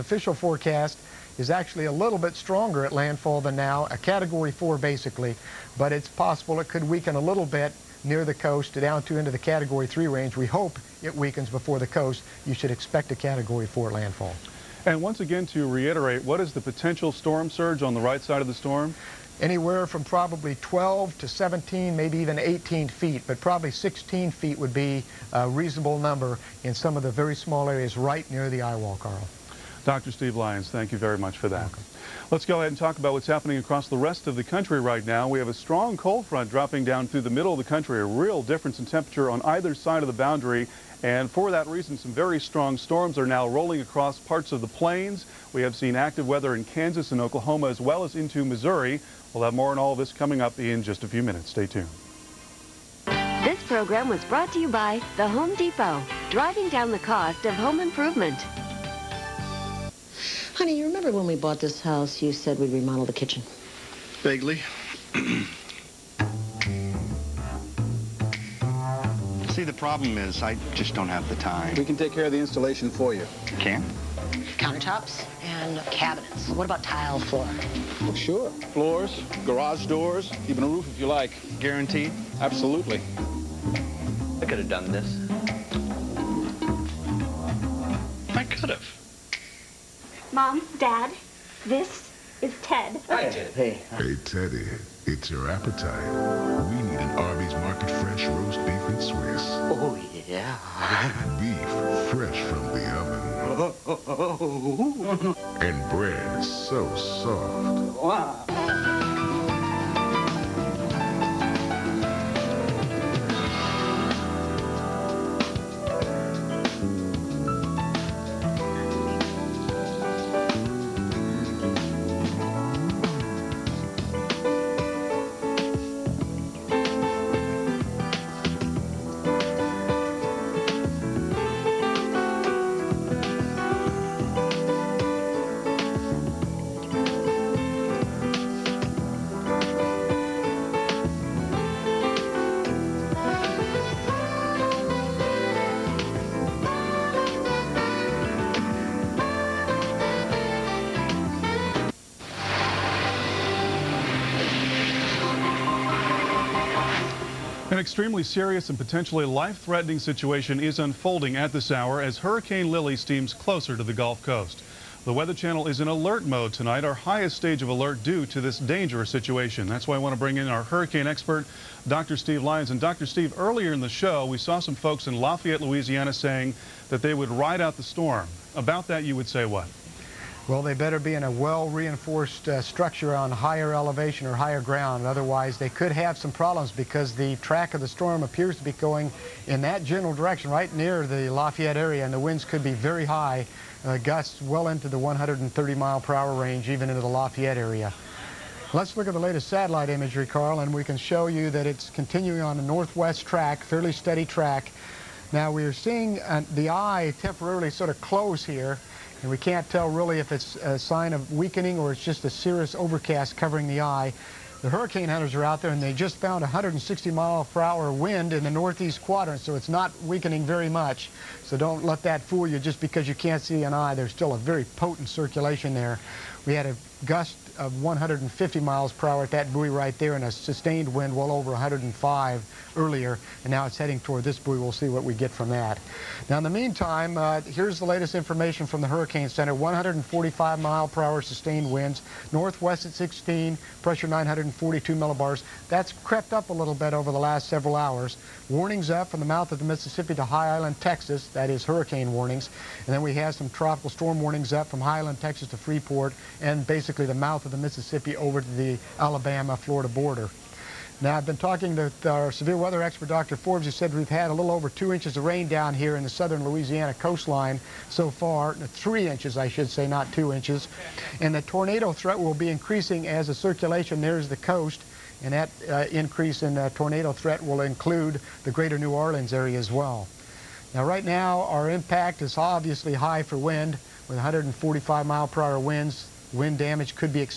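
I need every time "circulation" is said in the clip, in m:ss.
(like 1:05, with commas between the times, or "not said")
3:45, 4:33.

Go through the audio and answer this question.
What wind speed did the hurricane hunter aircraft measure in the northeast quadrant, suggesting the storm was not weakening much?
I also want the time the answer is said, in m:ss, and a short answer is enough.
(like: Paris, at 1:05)
160 mph, at 3:36.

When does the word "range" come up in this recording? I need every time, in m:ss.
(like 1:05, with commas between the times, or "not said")
0:10, 3:16.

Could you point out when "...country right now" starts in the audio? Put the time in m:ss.
0:34.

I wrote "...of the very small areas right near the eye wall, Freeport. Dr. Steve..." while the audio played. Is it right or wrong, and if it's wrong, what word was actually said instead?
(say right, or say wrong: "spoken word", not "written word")
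wrong: "Carl", not "Freeport".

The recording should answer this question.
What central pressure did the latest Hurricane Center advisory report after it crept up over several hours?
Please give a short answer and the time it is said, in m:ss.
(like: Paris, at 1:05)
942 millibars, at 4:04.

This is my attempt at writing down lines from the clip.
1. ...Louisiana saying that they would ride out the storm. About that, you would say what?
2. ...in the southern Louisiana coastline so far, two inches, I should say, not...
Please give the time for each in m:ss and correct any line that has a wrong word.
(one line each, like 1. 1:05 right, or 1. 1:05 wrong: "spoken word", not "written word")
1. 2:55 right
2. 4:25 wrong: "three", not "two".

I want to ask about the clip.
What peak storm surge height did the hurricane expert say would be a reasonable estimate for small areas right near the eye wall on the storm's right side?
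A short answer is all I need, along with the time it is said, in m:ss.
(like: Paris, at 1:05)
16 feet, at 0:23.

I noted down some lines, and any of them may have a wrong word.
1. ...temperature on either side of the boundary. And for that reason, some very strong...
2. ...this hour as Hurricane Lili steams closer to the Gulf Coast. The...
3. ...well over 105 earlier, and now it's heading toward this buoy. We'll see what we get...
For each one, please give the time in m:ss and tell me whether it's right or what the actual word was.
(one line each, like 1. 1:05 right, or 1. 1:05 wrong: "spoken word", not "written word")
1. 0:38 right
2. 2:41 right
3. 3:51 right.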